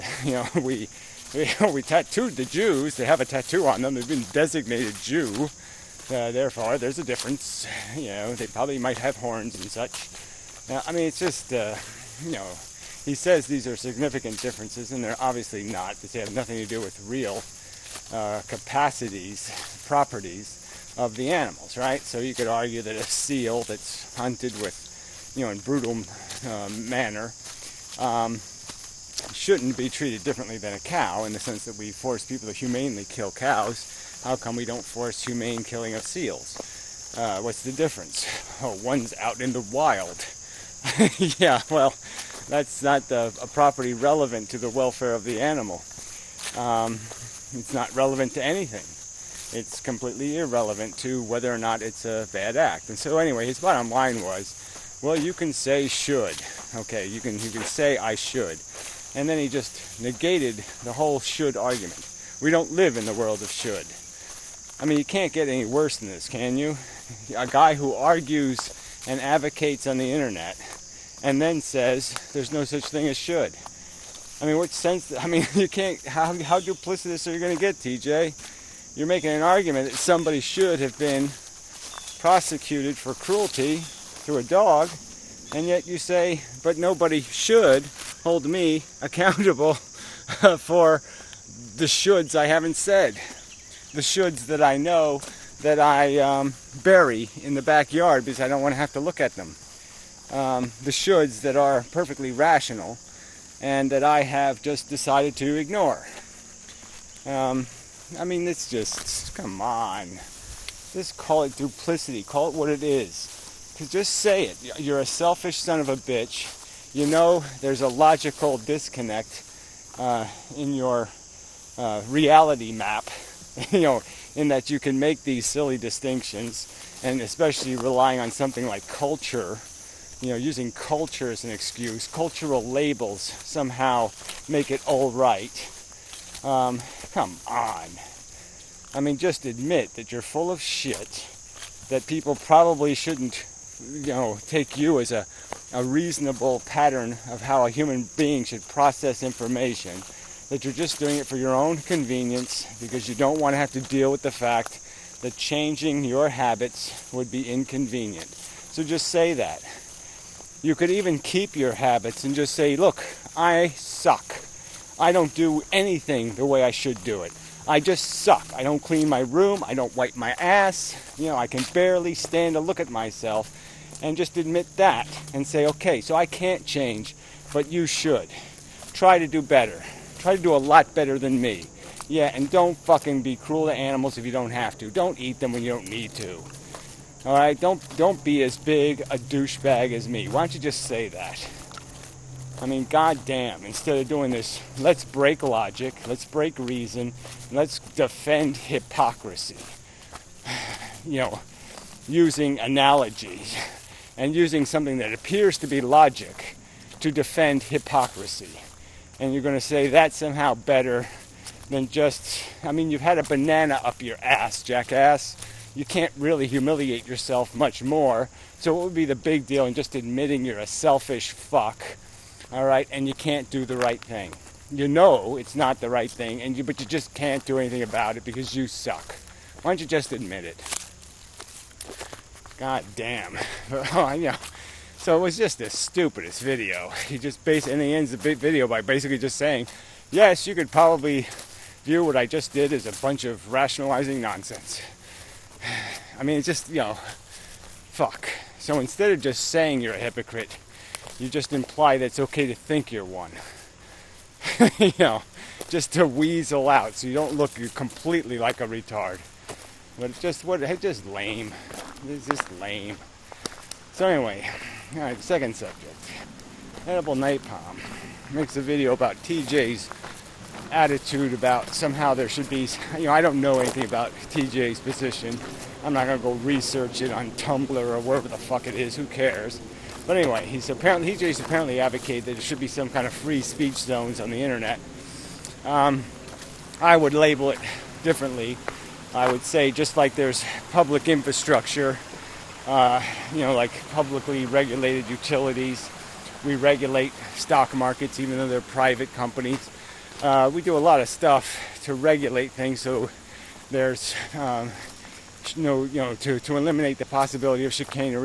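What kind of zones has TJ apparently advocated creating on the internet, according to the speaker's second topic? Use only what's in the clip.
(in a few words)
Free speech zones.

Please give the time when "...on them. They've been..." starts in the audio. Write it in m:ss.
0:03.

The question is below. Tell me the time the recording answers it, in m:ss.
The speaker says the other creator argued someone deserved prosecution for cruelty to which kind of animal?
1:24.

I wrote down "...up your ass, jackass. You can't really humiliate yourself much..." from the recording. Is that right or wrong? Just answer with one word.
right.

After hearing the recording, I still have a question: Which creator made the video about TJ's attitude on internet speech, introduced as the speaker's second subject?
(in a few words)
Edible Napalm.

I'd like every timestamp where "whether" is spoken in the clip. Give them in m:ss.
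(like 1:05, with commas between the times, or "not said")
0:51.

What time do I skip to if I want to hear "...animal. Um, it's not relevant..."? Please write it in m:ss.
0:45.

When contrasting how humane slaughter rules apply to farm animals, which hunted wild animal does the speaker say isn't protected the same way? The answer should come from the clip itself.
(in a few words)
Seal.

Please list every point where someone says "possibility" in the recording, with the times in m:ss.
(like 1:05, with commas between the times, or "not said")
5:07.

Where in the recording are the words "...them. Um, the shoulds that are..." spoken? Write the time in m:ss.
1:39.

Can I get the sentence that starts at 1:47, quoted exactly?
Um, I mean, it's just, come on.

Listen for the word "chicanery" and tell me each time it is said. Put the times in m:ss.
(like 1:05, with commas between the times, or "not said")
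5:07.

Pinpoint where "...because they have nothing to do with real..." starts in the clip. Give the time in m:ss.
0:15.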